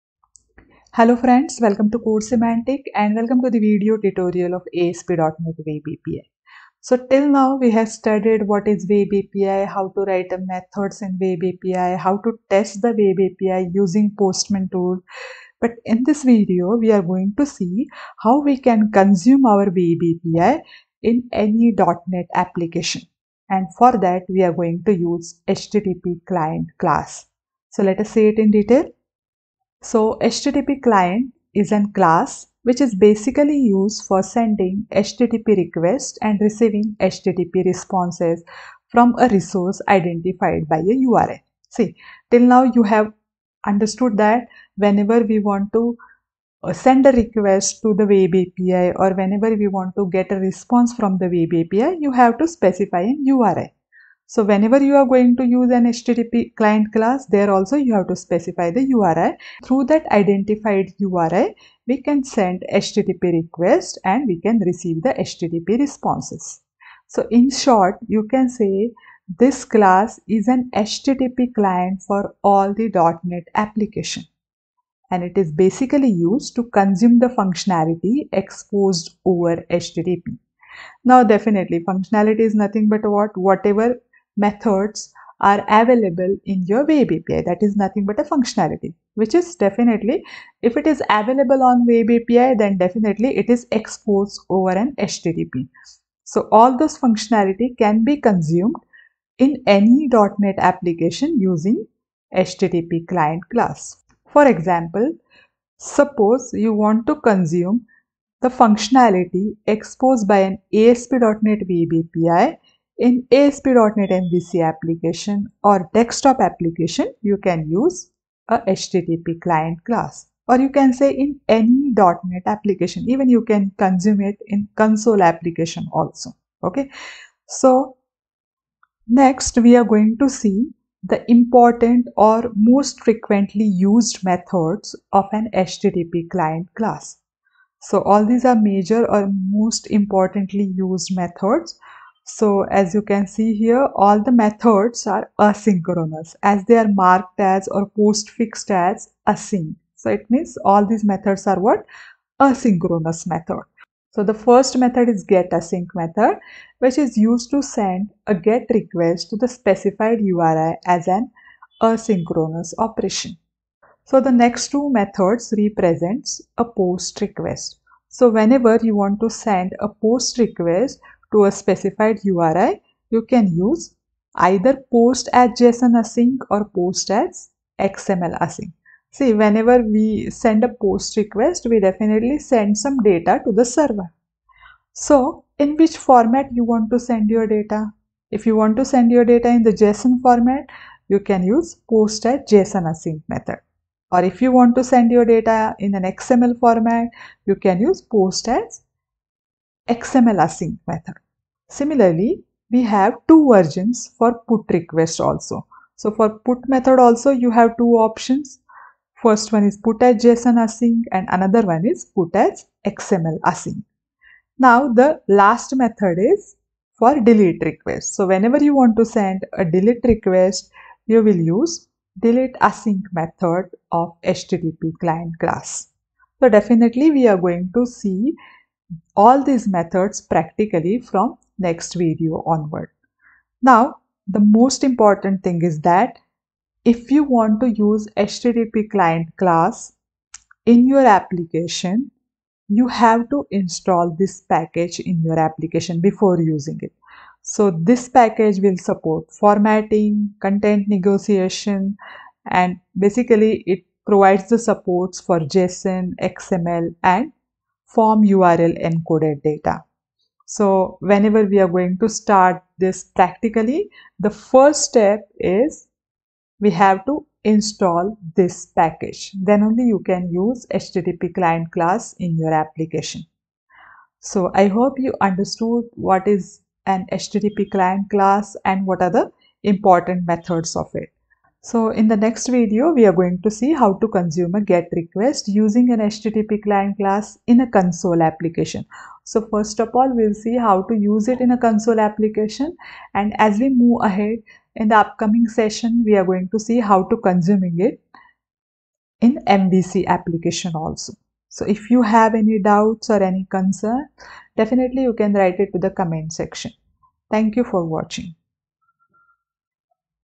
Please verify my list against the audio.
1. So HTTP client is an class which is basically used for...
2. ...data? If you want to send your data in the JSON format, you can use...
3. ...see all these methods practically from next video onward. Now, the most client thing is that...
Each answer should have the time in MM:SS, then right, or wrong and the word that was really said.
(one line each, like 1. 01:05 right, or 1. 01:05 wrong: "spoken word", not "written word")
1. 00:29 right
2. 03:07 right
3. 03:47 wrong: "important", not "client".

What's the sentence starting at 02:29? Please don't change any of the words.
So it means all these methods are what?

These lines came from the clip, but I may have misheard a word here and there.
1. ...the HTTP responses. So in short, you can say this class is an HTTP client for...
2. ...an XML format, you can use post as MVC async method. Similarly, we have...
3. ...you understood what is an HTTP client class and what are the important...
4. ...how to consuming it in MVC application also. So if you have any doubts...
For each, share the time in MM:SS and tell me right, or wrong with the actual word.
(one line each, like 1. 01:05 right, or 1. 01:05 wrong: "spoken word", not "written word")
1. 01:05 right
2. 03:15 wrong: "XML", not "MVC"
3. 04:34 right
4. 04:56 right.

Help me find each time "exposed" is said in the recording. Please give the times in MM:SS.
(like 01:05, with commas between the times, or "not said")
01:18, 01:33, 01:49.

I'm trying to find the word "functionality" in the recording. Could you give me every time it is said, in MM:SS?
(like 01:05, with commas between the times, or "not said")
01:17, 01:21, 01:28, 01:36, 01:48.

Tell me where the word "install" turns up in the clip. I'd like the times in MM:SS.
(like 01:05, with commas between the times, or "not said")
04:03, 04:27.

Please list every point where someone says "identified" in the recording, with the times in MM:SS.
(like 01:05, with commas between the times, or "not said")
00:39, 01:00.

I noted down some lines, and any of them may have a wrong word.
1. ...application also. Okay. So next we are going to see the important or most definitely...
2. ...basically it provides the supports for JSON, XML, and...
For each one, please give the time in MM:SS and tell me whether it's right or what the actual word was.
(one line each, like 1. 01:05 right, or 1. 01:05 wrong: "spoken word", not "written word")
1. 02:05 wrong: "frequently", not "definitely"
2. 04:12 right.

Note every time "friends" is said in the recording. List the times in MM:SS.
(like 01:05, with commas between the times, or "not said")
00:01.